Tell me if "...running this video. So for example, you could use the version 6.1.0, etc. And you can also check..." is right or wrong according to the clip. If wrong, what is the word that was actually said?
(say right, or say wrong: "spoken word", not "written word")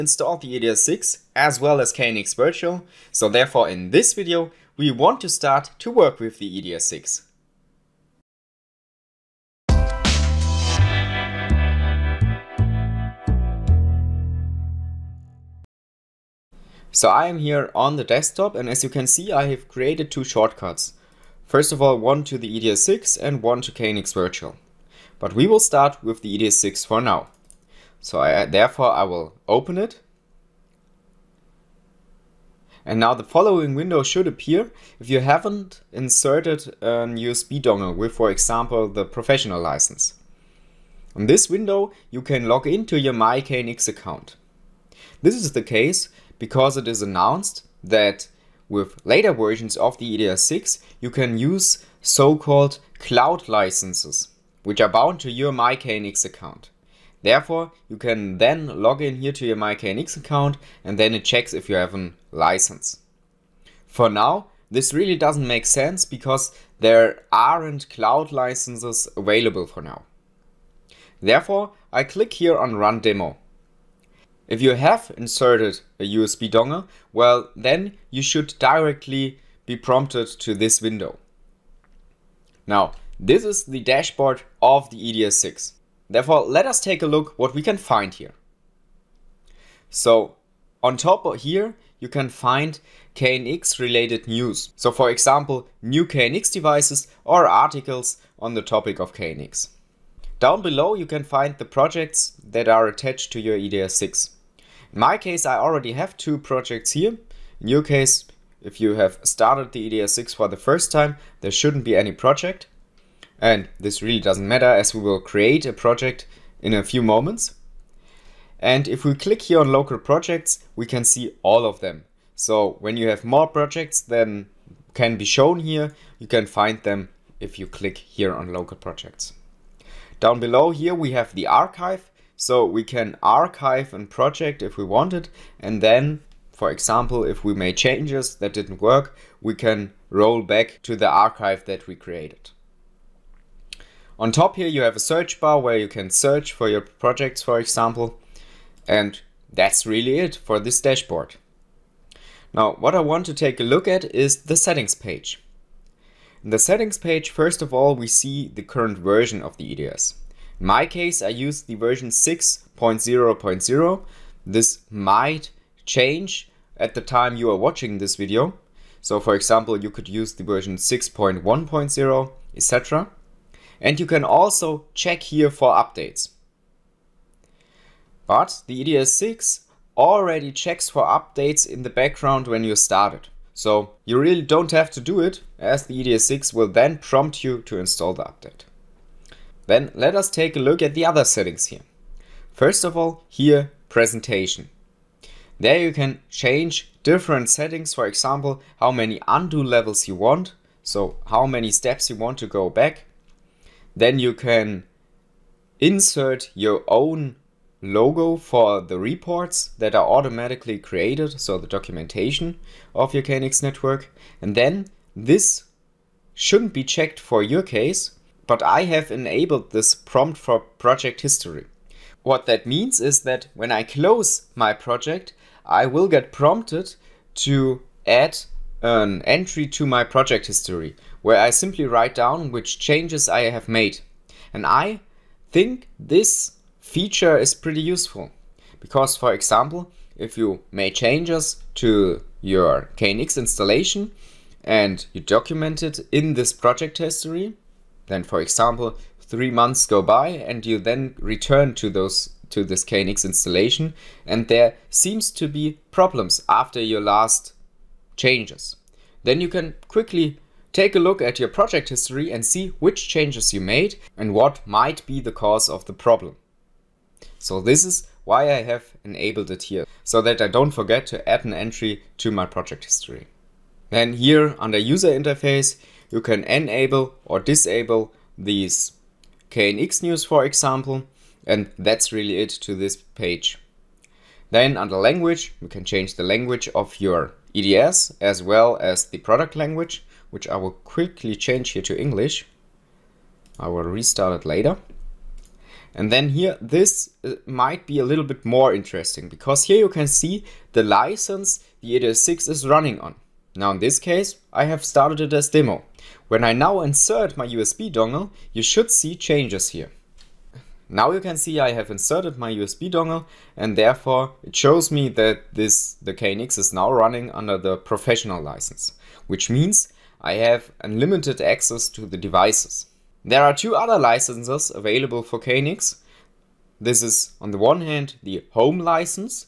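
wrong: "watching", not "running".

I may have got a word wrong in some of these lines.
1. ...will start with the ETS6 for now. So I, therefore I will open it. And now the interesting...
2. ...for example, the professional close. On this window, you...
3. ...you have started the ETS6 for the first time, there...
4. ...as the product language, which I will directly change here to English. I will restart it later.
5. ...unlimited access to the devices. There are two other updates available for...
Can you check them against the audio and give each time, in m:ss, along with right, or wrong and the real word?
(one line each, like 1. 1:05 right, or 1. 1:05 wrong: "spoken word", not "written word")
1. 0:25 wrong: "following", not "interesting"
2. 0:38 wrong: "license", not "close"
3. 1:48 right
4. 4:48 wrong: "quickly", not "directly"
5. 5:20 wrong: "licenses", not "updates".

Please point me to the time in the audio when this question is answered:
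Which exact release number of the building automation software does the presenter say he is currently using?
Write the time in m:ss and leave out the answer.
2:42.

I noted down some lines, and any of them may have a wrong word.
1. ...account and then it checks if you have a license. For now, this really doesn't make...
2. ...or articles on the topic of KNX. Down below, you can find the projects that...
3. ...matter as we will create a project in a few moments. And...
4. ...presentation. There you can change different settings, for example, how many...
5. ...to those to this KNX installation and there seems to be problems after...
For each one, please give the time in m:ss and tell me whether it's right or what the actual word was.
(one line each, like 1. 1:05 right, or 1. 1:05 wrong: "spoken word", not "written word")
1. 1:00 right
2. 1:37 right
3. 1:54 right
4. 3:13 right
5. 4:11 right.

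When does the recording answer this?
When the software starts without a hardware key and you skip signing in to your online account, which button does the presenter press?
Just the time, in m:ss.
1:12.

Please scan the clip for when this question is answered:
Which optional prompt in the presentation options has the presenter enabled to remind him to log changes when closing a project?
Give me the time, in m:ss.
3:39.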